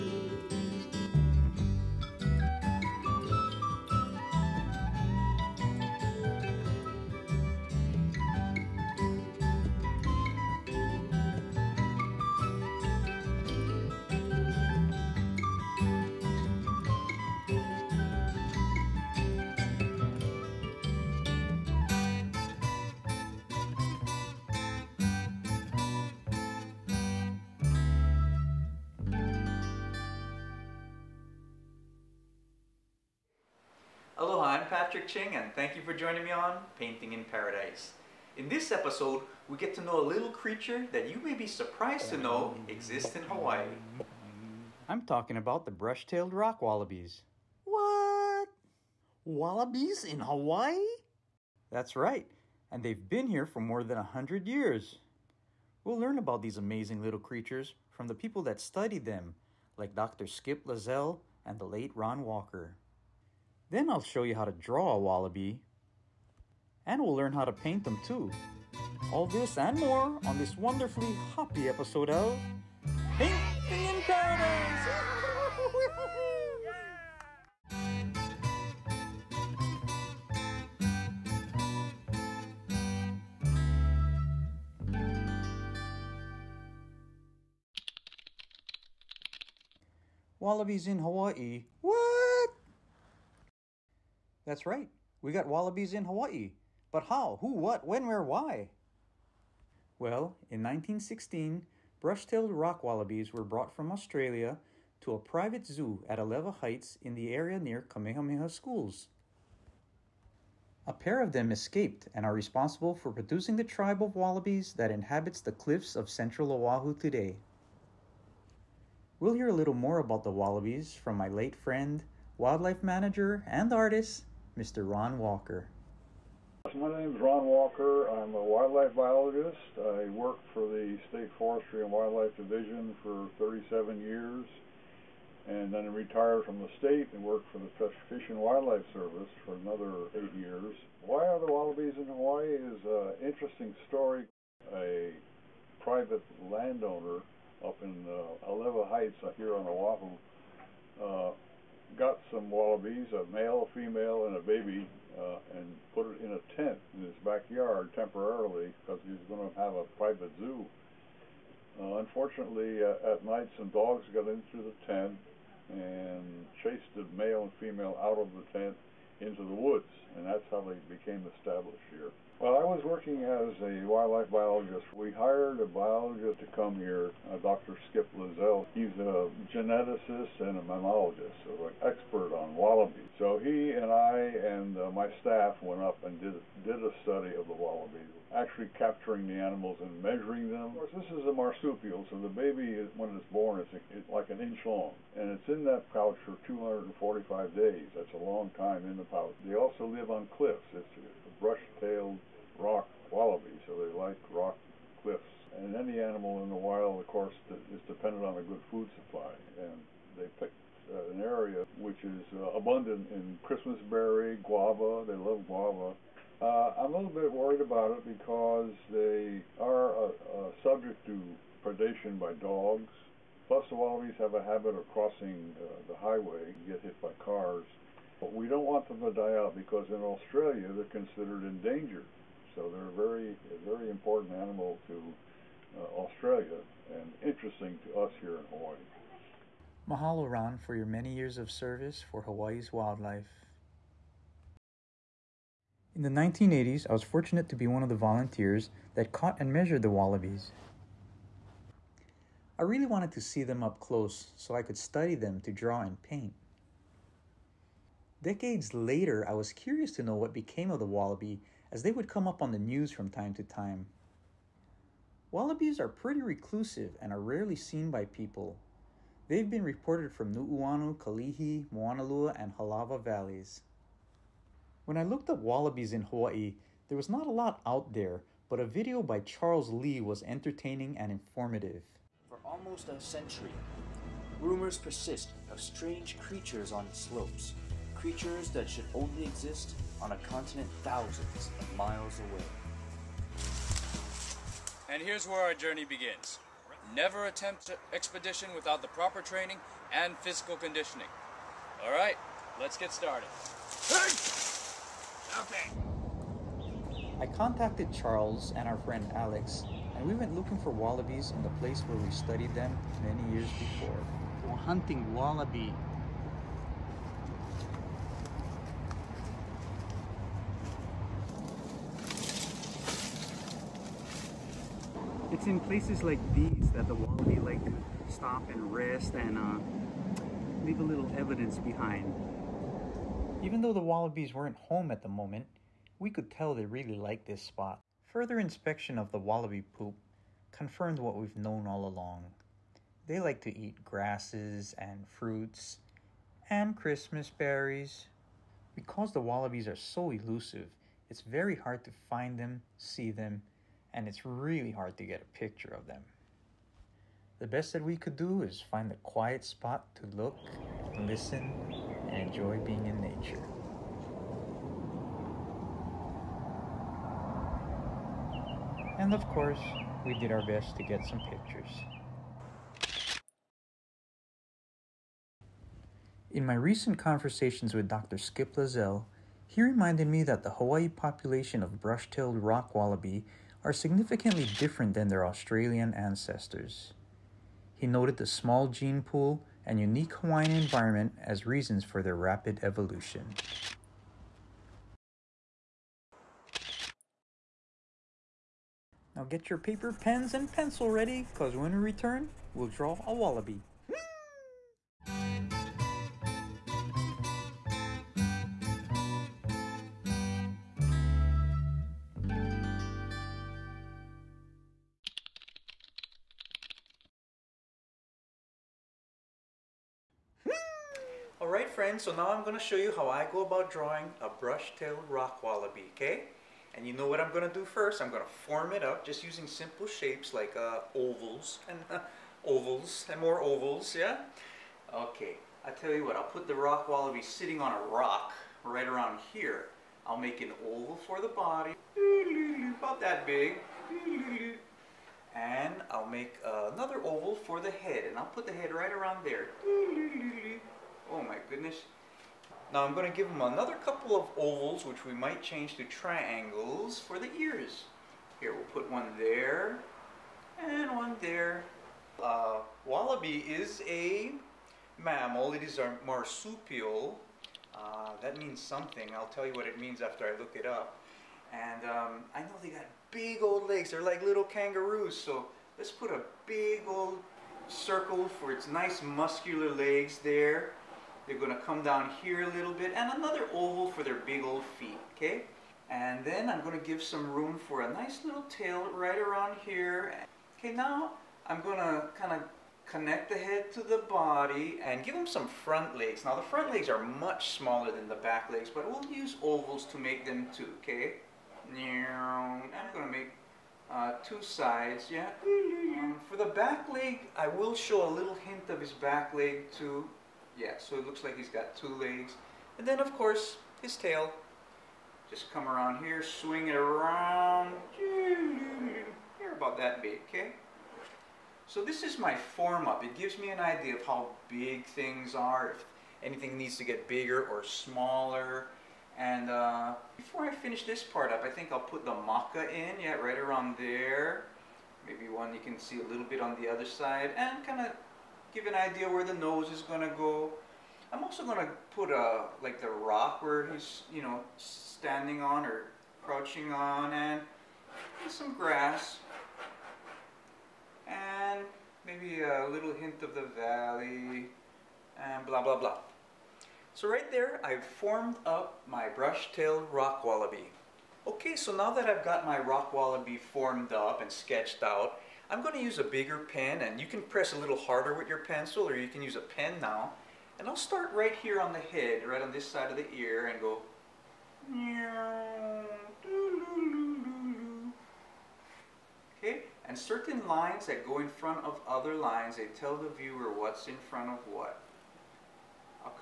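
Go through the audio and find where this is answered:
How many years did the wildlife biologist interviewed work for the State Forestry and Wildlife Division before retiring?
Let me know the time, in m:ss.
2:13.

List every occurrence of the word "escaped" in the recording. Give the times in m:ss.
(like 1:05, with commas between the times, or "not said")
1:51.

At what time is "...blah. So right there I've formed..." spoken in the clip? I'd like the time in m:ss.
9:15.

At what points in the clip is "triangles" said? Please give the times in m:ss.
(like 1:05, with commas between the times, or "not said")
7:35.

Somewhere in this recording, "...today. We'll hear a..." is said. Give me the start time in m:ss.
1:56.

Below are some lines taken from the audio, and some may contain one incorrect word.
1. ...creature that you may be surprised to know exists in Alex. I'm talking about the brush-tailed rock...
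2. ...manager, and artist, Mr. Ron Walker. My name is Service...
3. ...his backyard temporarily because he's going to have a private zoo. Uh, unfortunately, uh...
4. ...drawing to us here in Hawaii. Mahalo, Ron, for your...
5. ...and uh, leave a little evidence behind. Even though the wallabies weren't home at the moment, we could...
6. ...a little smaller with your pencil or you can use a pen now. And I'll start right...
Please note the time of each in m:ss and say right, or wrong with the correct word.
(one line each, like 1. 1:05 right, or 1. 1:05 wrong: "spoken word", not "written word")
1. 0:40 wrong: "Hawaii", not "Alex"
2. 2:02 wrong: "Ron", not "Service"
3. 2:37 right
4. 3:57 wrong: "interesting", not "drawing"
5. 5:29 right
6. 9:27 wrong: "harder", not "smaller".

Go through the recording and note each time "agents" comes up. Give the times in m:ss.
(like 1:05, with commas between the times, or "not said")
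not said.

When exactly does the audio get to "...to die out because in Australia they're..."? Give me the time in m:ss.
3:49.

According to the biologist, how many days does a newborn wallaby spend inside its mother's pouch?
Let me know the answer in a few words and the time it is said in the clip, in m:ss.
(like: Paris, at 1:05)
245, at 3:16.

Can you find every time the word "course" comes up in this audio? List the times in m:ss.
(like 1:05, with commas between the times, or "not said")
3:10, 3:27, 6:09, 8:33.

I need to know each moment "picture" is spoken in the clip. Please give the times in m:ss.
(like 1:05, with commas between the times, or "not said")
5:55, 6:11.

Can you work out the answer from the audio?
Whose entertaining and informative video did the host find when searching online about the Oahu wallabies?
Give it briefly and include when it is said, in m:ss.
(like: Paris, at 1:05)
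Charles Lee, at 4:39.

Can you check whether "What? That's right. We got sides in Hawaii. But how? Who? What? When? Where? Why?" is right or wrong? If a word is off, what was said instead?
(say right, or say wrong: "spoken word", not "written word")
wrong: "wallabies", not "sides".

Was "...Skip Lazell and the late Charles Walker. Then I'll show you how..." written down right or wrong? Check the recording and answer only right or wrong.
wrong.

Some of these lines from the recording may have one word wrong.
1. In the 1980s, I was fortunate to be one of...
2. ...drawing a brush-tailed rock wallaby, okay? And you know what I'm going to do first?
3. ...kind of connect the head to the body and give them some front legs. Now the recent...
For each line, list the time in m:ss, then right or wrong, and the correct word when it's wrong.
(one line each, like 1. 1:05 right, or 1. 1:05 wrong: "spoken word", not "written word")
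1. 4:05 right
2. 7:03 right
3. 8:12 wrong: "front", not "recent".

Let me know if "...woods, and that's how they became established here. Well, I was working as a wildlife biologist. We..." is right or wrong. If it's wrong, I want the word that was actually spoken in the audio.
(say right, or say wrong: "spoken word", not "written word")
right.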